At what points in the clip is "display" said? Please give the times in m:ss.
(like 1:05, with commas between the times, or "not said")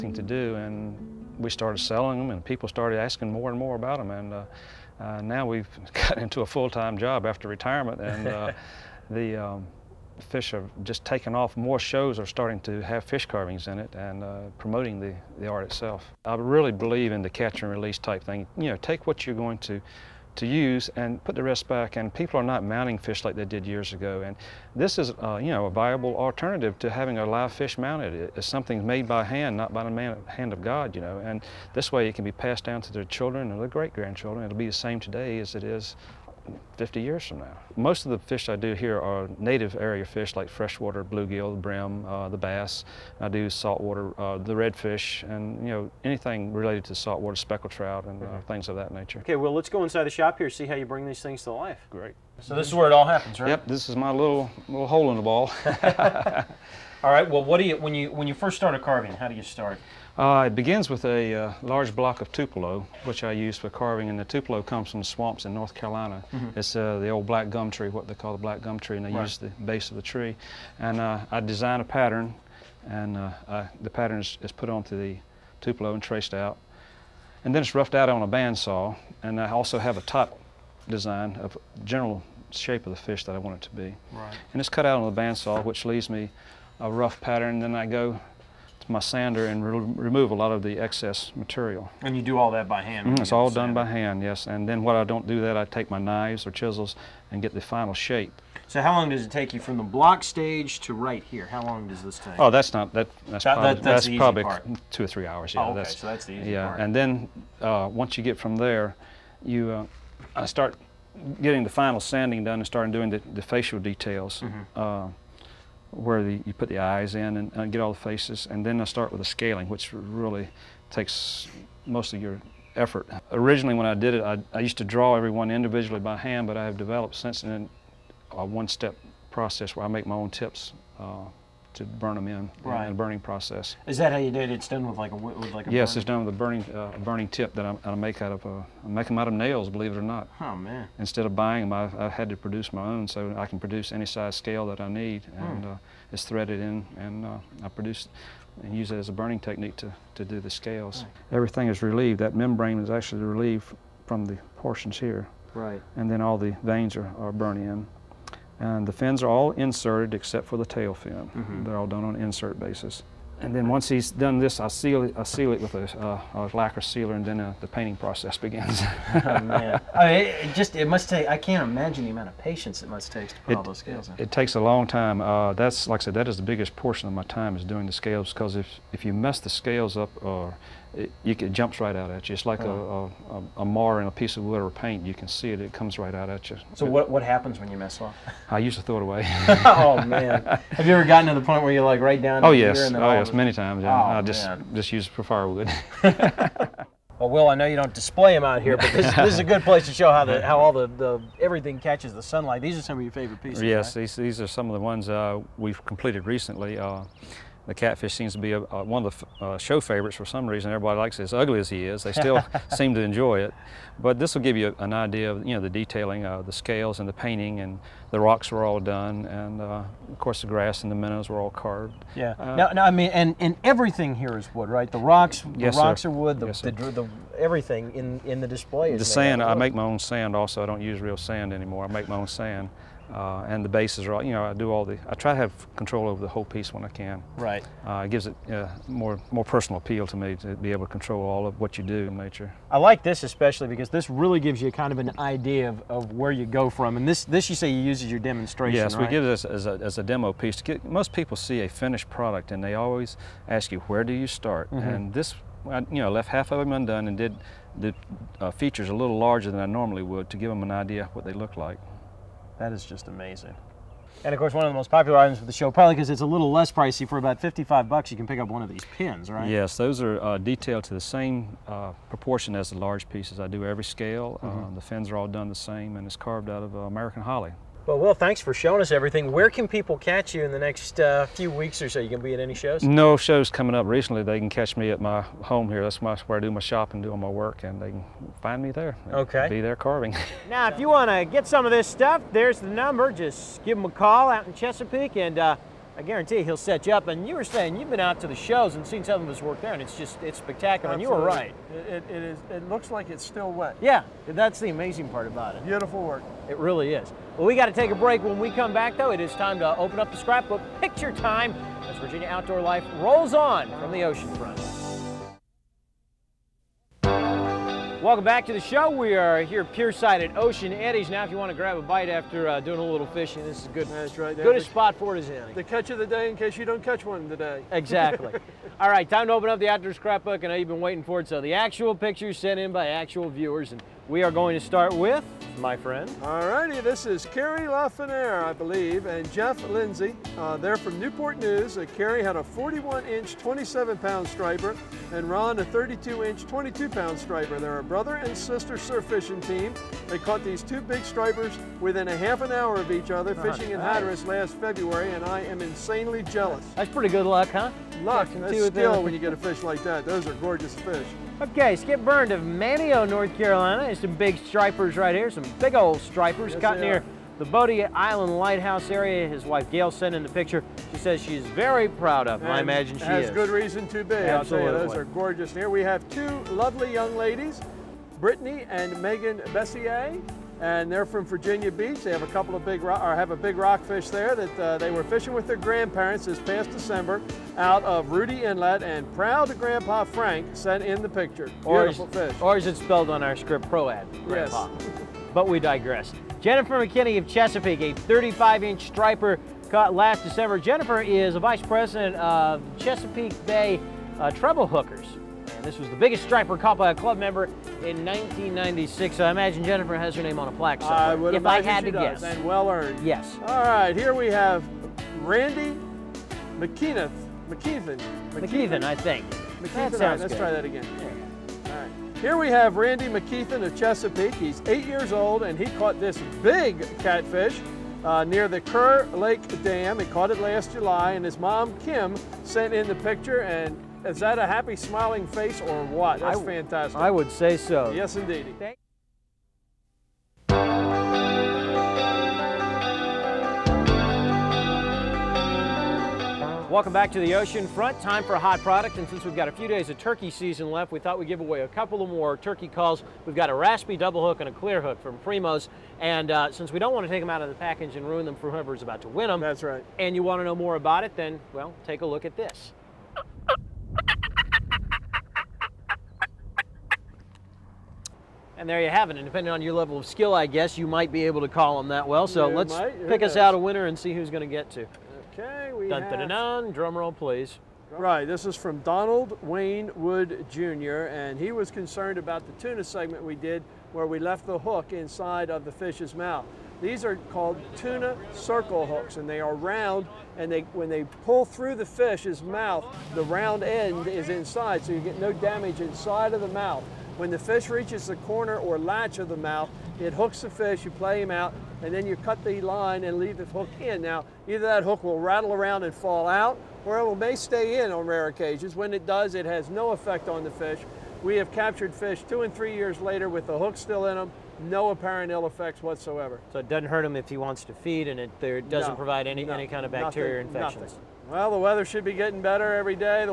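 3:17, 3:48.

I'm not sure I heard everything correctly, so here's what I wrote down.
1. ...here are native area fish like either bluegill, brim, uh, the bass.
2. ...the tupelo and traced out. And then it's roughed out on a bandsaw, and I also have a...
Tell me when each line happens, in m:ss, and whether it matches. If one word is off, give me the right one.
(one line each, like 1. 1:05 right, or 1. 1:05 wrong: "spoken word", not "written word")
1. 0:38 wrong: "freshwater", not "either"
2. 1:14 right.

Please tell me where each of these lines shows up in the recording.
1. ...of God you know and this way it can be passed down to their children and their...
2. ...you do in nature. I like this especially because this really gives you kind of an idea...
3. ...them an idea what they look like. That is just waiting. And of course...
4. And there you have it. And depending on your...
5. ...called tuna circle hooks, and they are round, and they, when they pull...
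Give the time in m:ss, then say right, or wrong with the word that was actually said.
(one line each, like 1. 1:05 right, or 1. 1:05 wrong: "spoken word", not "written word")
1. 0:30 right
2. 4:01 right
3. 4:20 wrong: "amazing", not "waiting"
4. 7:48 right
5. 8:07 right.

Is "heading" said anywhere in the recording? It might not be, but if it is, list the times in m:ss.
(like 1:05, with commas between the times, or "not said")
not said.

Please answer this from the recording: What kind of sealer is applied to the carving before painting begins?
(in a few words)
Lacquer sealer.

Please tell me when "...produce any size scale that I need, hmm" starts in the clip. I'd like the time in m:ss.
2:23.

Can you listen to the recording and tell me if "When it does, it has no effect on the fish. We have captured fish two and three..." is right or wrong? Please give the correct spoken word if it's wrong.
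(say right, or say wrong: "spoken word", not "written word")
right.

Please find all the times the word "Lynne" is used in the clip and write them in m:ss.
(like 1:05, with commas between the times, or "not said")
not said.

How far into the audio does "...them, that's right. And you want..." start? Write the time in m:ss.
7:39.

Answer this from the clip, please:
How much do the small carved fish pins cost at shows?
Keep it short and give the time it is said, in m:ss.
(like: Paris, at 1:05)
$55, at 4:27.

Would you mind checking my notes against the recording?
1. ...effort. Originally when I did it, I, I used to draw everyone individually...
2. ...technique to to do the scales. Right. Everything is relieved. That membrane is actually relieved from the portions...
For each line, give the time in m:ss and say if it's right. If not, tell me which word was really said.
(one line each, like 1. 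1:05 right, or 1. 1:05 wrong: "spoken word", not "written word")
1. 2:02 right
2. 2:29 right.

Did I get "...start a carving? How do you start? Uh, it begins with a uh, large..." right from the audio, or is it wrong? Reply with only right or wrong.
right.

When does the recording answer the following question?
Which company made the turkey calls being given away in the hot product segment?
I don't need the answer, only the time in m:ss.
7:35.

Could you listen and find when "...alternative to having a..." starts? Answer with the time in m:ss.
0:26.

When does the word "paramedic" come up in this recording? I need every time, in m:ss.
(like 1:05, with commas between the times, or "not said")
not said.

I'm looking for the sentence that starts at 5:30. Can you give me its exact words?
and I know you've been waiting for it.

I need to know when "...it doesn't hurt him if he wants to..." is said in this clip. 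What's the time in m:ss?
8:36.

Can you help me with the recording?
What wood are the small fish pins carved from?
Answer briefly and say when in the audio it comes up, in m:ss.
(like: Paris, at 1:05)
American holly, at 4:36.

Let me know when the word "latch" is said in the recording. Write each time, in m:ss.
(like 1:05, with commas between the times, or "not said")
8:18.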